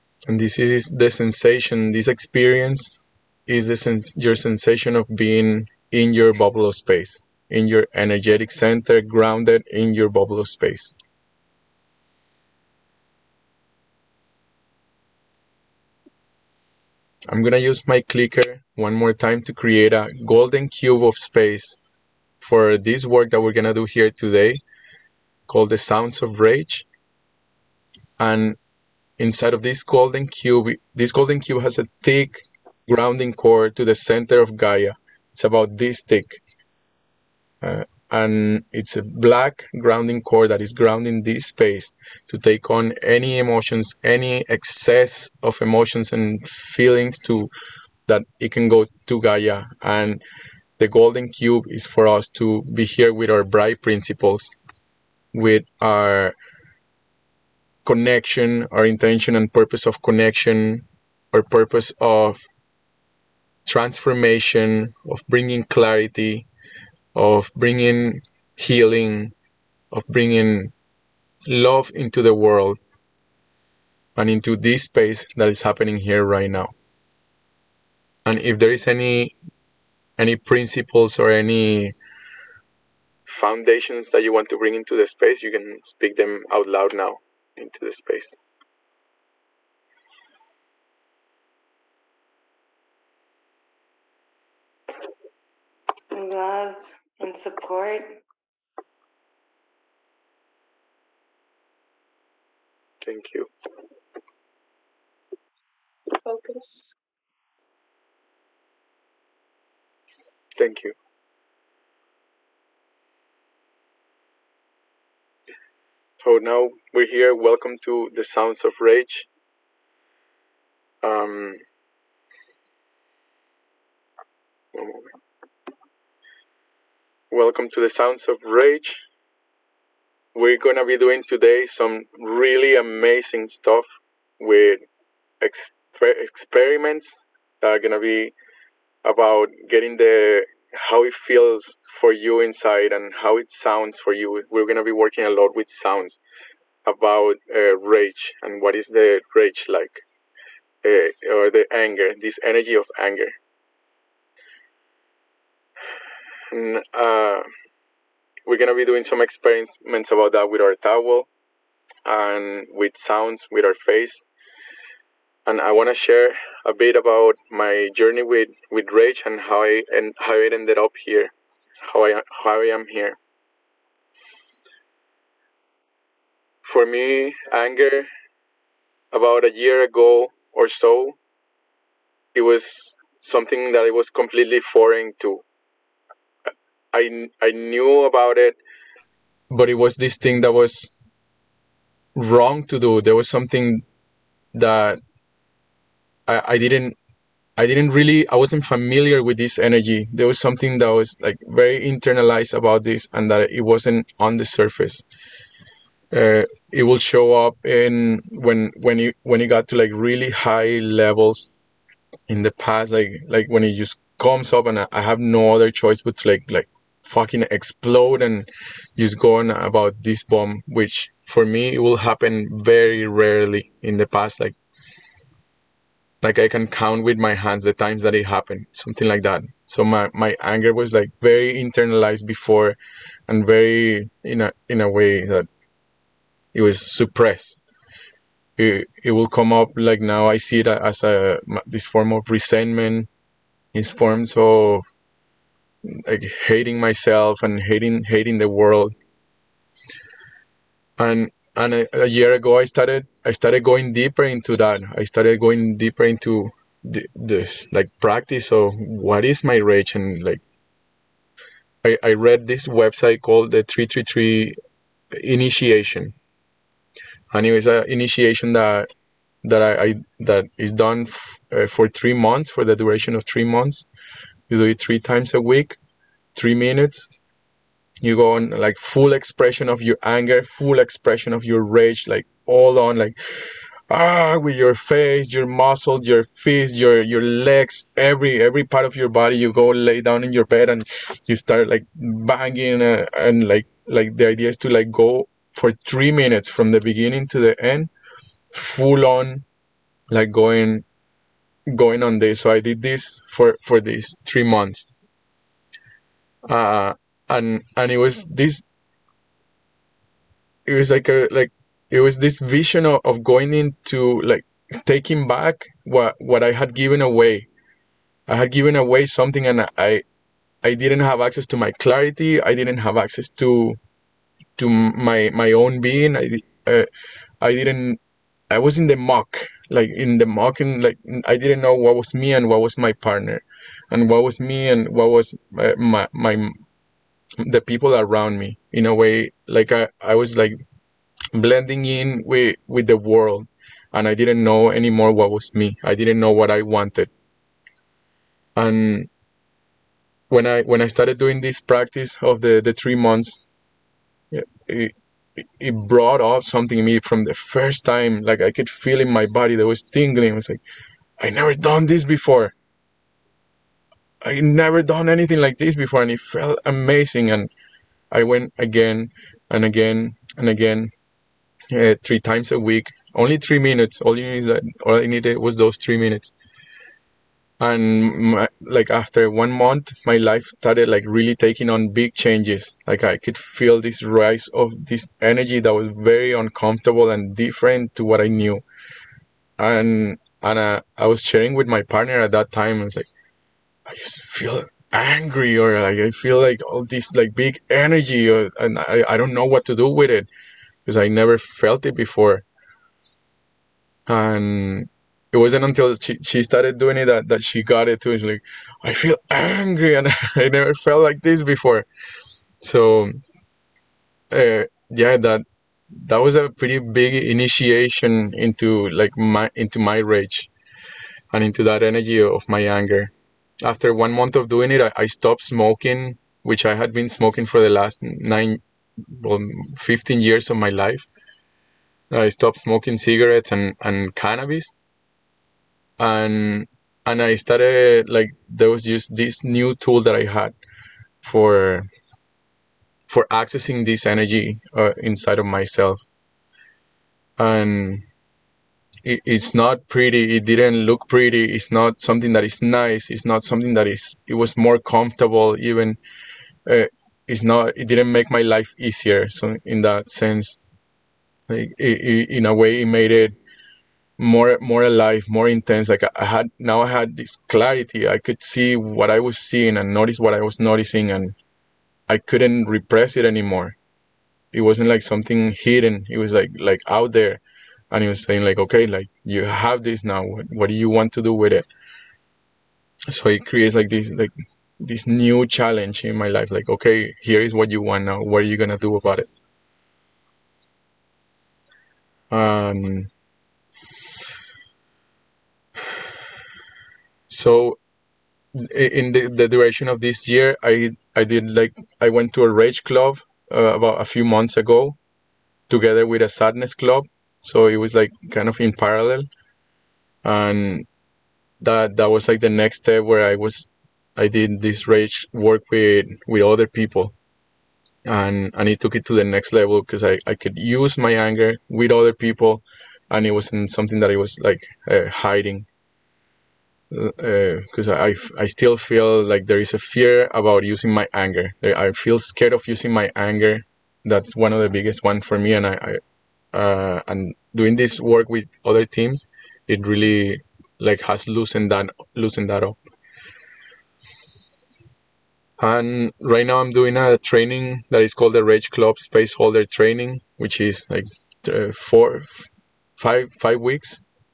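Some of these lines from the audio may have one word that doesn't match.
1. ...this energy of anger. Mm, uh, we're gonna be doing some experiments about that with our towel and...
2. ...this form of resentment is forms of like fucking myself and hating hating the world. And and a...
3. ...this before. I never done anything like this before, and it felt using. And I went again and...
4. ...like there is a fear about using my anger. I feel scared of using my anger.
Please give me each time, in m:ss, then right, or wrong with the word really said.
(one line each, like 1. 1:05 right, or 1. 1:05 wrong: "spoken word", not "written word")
1. 2:32 right
2. 4:01 wrong: "hating", not "fucking"
3. 6:01 wrong: "amazing", not "using"
4. 8:49 right.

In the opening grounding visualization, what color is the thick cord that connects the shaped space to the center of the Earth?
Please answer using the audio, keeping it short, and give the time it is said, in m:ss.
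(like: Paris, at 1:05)
black, at 0:39.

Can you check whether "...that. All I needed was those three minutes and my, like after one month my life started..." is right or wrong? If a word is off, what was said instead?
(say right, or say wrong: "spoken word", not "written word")
right.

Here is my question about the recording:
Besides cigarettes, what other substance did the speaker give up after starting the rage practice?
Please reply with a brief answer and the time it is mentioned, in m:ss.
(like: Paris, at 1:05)
cannabis, at 7:14.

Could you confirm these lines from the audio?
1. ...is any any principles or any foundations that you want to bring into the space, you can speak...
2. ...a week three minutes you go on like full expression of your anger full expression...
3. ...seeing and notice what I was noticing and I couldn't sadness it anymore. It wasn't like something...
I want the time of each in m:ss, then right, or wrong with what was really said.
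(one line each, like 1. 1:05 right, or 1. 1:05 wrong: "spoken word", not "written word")
1. 1:18 right
2. 4:35 right
3. 7:49 wrong: "repress", not "sadness".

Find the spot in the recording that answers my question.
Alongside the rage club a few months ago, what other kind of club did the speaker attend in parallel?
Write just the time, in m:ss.
8:26.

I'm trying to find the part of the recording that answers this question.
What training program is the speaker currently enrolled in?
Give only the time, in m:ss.
9:08.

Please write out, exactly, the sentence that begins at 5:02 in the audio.
So I did this for for these three months, uh, and and it was this.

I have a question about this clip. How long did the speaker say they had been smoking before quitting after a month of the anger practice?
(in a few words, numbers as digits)
15 years.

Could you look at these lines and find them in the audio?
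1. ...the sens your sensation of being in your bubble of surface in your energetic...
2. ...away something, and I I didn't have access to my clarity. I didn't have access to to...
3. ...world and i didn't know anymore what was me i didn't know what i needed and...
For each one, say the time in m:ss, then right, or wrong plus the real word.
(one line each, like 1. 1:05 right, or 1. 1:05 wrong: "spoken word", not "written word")
1. 0:03 wrong: "space", not "surface"
2. 5:18 right
3. 5:42 wrong: "wanted", not "needed".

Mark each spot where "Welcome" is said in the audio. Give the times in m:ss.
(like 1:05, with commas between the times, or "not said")
1:57, 2:07.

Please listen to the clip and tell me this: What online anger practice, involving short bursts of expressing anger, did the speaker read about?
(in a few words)
333 initiation.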